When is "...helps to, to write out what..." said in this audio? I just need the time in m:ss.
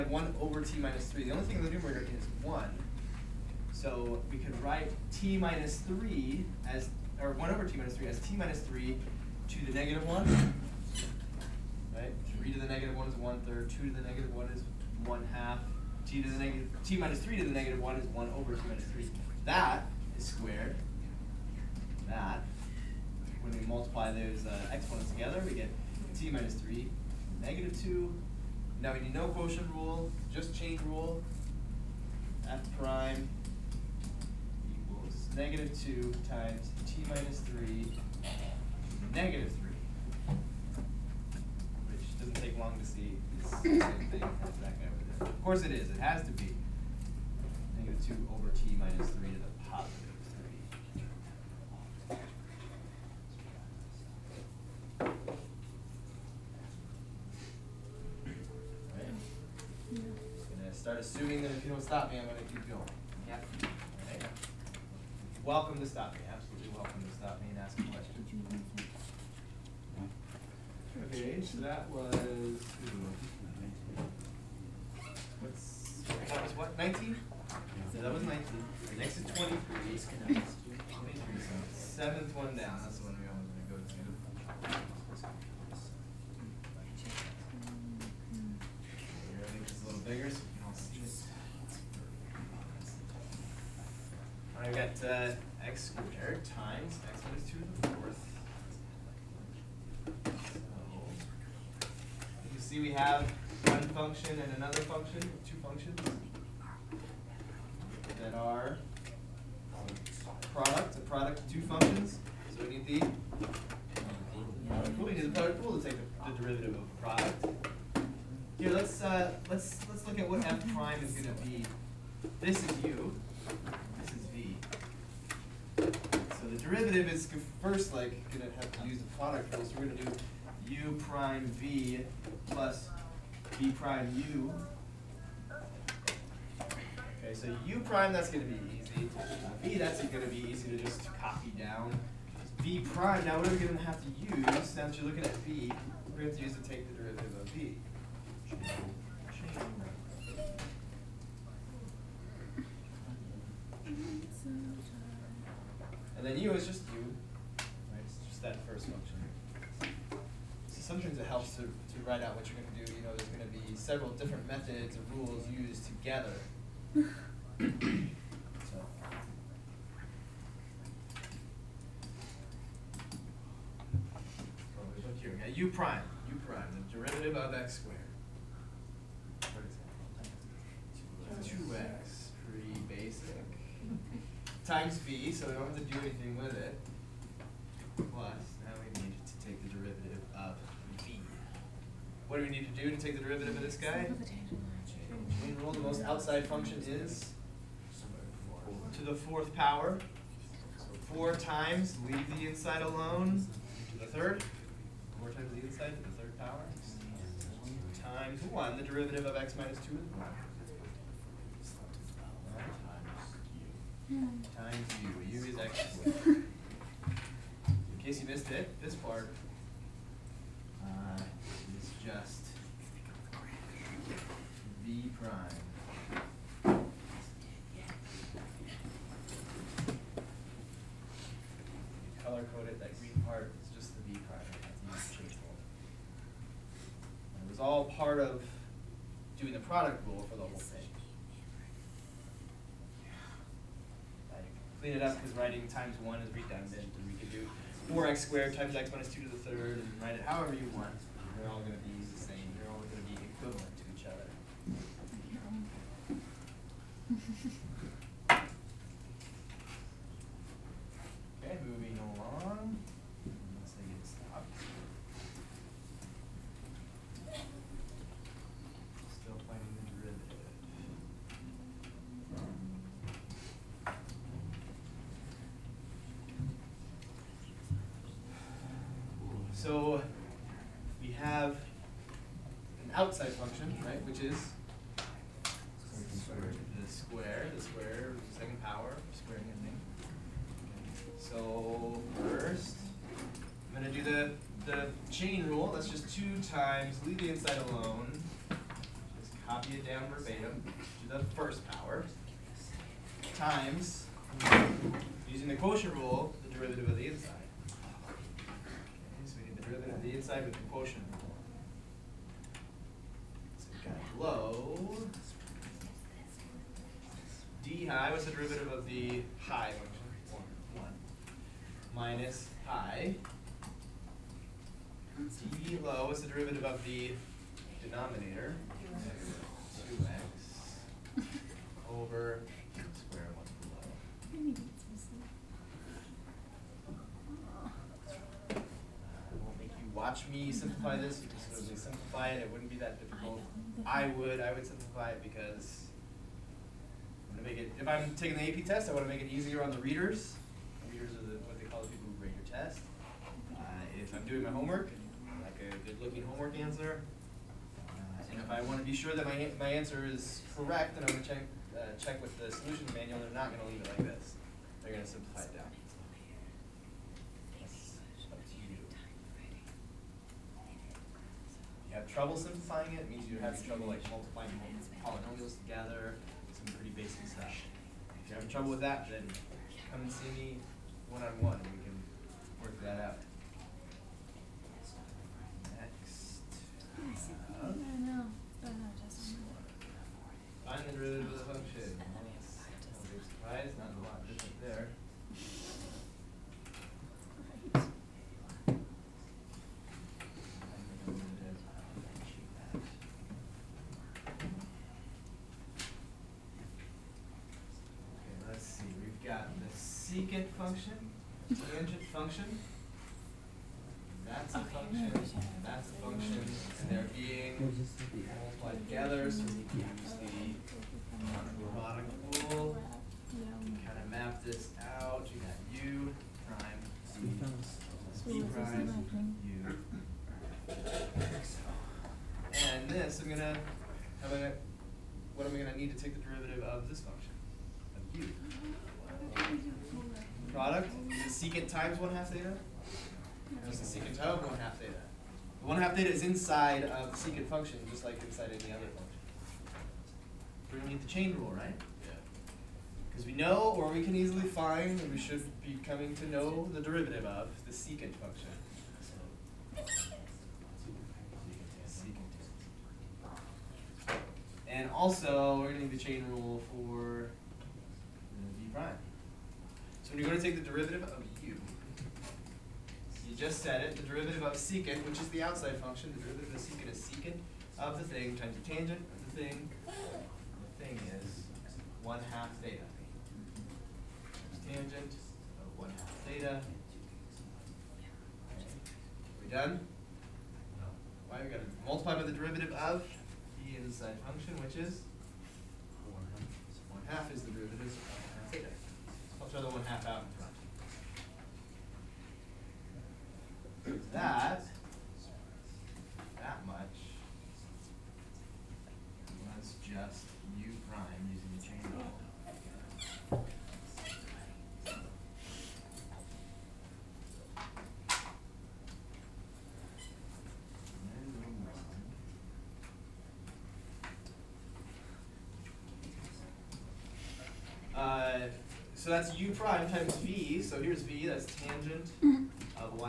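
2:41.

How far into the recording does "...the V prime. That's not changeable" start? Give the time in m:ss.
3:53.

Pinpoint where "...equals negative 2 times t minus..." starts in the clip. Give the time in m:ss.
0:34.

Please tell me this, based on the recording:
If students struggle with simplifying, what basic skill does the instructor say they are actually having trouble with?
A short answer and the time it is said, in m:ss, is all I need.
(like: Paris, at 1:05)
multiplying polynomials, at 6:14.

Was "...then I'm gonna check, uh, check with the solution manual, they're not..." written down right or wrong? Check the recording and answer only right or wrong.
right.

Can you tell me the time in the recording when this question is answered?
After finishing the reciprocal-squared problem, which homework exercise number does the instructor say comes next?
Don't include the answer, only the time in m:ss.
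1:18.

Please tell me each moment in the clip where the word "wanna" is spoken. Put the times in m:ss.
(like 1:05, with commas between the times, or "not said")
5:48, 5:58.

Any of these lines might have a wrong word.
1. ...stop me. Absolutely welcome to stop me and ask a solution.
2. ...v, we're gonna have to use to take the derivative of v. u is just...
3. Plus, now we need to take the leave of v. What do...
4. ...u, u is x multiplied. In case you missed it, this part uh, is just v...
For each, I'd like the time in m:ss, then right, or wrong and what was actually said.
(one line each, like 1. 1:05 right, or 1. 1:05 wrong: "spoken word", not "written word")
1. 1:05 wrong: "question", not "solution"
2. 2:25 right
3. 3:08 wrong: "derivative", not "leave"
4. 3:35 wrong: "squared", not "multiplied".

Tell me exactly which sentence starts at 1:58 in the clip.
Here, let's uh, let's let's look at what f prime is going to be.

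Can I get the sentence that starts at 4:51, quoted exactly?
So first, I'm going to do the, the chain rule.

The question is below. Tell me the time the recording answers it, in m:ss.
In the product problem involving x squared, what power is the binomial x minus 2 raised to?
1:37.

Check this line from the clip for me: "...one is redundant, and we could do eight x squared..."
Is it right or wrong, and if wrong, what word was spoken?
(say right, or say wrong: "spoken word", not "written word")
wrong: "four", not "eight".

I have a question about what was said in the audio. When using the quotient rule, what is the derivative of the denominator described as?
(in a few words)
2x.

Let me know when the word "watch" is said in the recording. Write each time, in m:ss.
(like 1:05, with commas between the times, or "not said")
5:39.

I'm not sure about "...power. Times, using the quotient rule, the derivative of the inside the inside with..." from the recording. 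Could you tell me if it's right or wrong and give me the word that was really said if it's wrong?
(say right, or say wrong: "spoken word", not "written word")
right.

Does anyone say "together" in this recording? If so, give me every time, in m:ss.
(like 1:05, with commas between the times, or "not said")
0:25, 2:45, 6:15, 6:58.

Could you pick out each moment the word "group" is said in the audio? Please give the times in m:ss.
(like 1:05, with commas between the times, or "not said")
not said.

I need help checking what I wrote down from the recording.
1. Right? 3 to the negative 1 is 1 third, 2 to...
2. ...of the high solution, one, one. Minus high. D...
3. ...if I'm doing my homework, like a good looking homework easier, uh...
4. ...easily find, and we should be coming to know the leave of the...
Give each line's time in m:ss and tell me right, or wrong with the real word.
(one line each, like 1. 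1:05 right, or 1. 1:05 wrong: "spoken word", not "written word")
1. 0:11 right
2. 5:18 wrong: "function", not "solution"
3. 5:53 wrong: "answer", not "easier"
4. 7:34 wrong: "derivative", not "leave".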